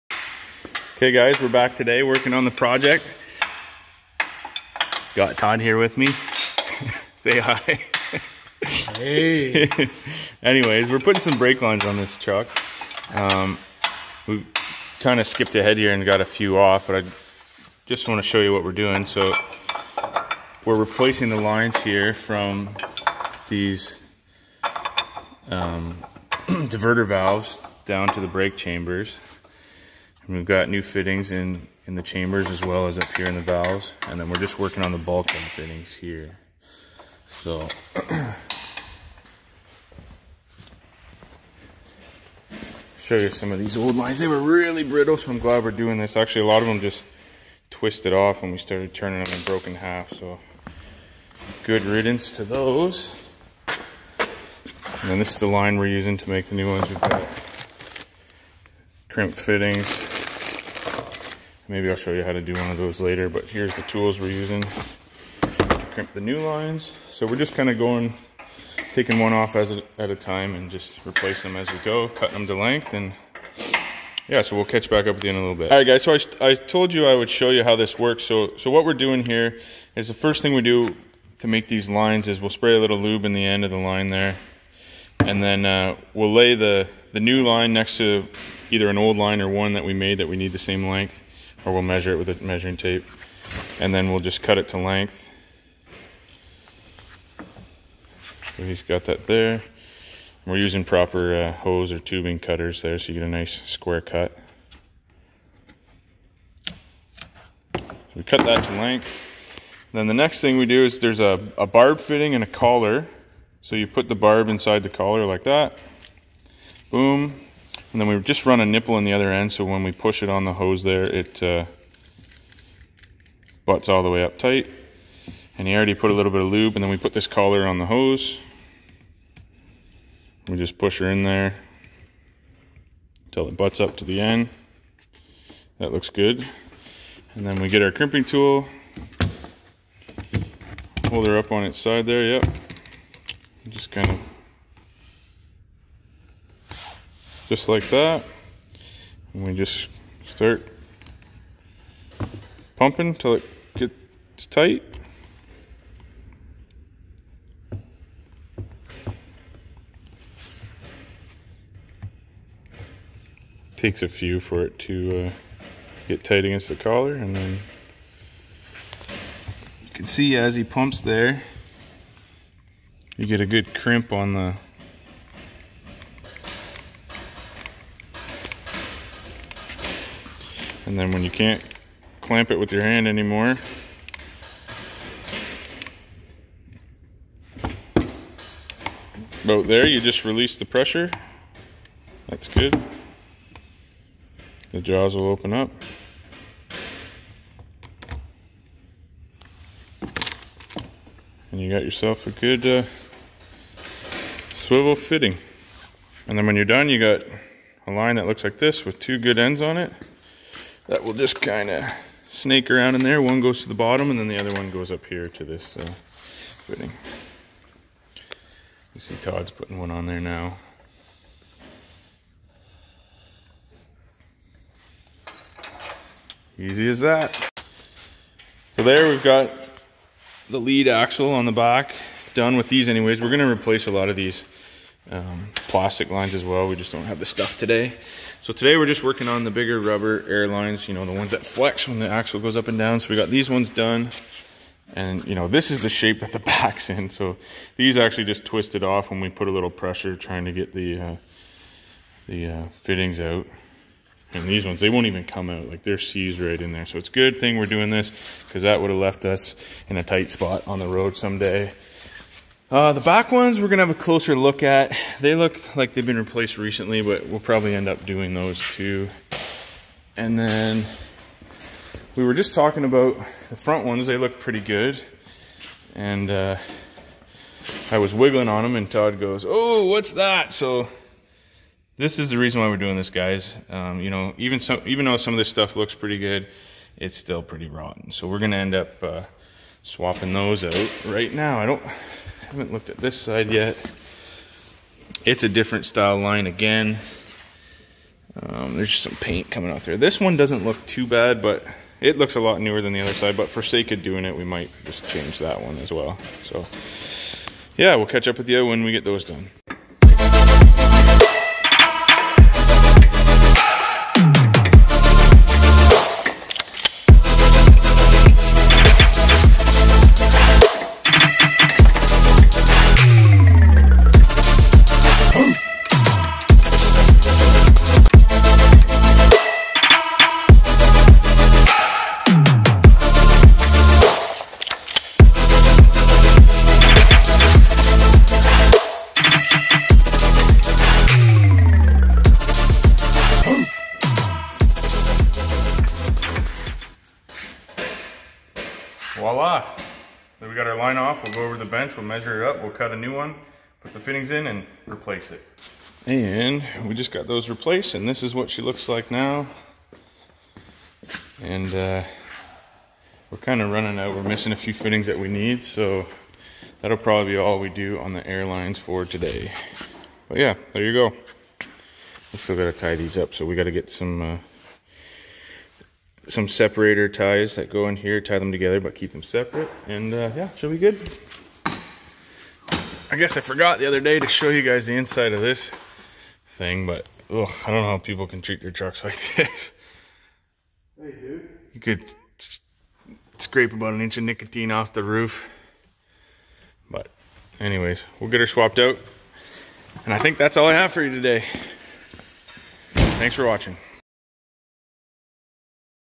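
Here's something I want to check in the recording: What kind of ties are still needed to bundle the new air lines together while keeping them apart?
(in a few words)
separator ties.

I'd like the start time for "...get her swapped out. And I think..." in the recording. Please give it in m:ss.
6:38.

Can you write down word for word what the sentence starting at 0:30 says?
We've got new fittings in, in the chambers as well as up here in the valves.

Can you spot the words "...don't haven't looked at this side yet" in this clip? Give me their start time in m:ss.
4:51.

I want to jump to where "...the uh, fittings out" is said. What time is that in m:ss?
4:12.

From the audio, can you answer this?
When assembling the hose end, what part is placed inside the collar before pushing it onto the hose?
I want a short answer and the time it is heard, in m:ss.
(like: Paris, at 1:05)
barb fitting, at 1:51.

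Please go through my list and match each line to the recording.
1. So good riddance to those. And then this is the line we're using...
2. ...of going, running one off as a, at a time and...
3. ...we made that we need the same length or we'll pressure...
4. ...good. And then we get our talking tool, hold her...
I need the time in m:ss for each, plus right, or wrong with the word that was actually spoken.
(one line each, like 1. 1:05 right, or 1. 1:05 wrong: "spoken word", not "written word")
1. 0:50 right
2. 1:07 wrong: "taking", not "running"
3. 1:29 wrong: "measure", not "pressure"
4. 2:16 wrong: "crimping", not "talking".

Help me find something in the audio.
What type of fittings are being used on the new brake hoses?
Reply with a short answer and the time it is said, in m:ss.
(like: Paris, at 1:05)
crimp fittings, at 0:59.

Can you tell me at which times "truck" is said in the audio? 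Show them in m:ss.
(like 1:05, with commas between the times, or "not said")
0:12, 6:28.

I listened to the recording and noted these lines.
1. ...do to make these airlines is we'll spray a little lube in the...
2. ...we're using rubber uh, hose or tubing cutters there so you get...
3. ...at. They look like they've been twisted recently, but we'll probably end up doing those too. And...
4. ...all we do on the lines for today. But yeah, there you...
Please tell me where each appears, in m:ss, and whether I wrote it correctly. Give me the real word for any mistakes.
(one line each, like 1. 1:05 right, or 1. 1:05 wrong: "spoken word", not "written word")
1. 1:20 wrong: "lines", not "airlines"
2. 1:40 wrong: "proper", not "rubber"
3. 4:24 wrong: "replaced", not "twisted"
4. 6:07 wrong: "airlines", not "lines".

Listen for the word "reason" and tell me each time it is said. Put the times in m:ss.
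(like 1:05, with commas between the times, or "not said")
4:42.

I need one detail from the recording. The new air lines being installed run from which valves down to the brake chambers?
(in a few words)
diverter valves.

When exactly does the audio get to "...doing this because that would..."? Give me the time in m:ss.
4:17.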